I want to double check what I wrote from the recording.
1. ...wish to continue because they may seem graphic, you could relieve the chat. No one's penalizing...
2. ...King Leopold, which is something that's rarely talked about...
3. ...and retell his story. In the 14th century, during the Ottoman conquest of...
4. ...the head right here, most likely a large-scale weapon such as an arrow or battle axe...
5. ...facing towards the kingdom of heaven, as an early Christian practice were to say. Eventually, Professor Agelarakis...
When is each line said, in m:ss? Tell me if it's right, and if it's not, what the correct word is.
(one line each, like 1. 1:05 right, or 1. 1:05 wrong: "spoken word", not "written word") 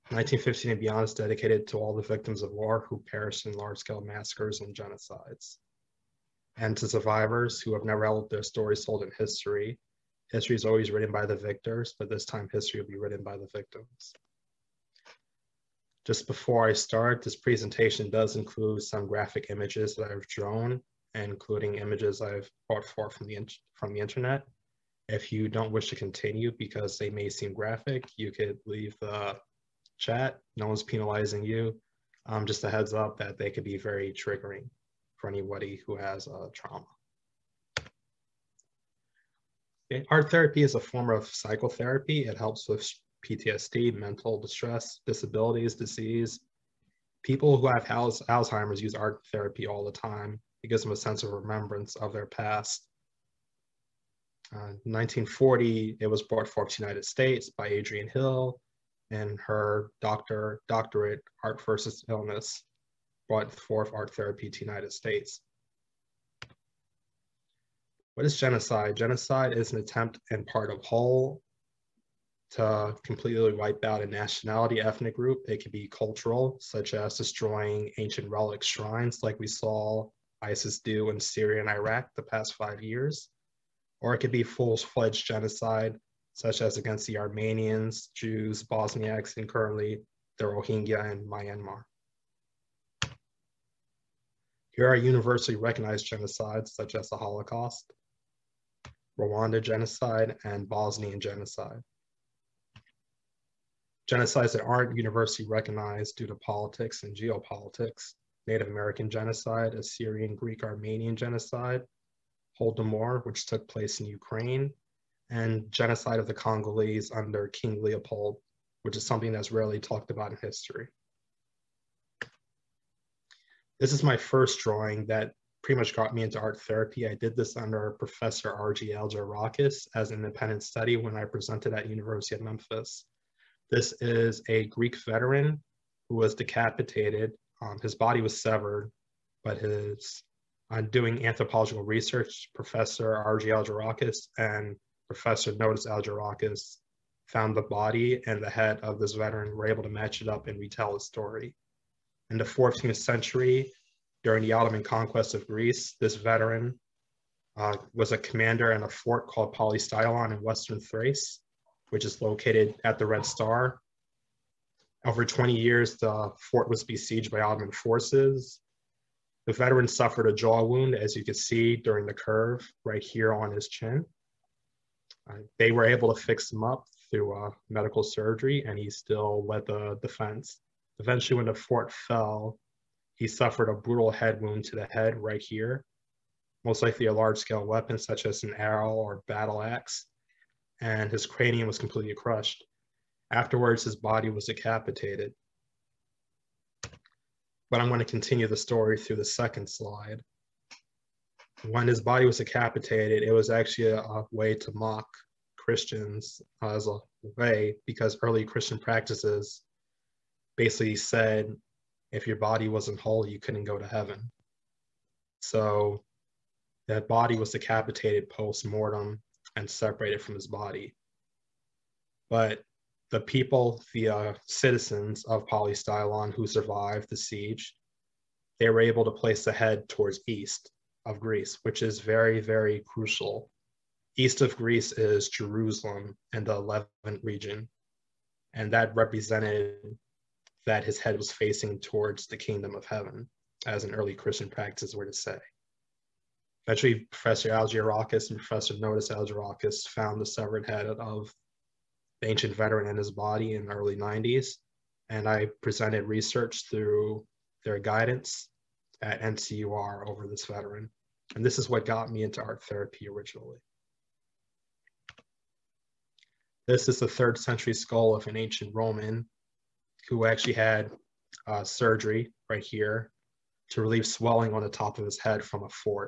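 1. 0:25 wrong: "leave", not "relieve"
2. 1:57 right
3. 2:30 right
4. 3:04 right
5. 4:01 right.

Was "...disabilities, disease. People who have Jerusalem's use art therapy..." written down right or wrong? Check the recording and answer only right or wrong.
wrong.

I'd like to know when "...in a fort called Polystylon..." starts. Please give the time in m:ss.
2:38.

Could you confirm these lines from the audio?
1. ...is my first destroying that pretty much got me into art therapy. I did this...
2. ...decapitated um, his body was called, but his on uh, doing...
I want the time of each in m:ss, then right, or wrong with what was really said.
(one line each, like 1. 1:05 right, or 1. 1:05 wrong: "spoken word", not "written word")
1. 2:03 wrong: "drawing", not "destroying"
2. 2:16 wrong: "severed", not "called".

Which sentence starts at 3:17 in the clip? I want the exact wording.
But I'm going to continue the story through the second slide.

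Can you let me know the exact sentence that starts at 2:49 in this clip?
The veteran suffered a jaw wound, as you can see during the curve right here on his chin.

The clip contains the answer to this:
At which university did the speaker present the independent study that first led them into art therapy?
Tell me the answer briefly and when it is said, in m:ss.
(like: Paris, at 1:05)
University of Memphis, at 2:11.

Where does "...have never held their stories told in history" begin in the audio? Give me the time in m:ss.
0:07.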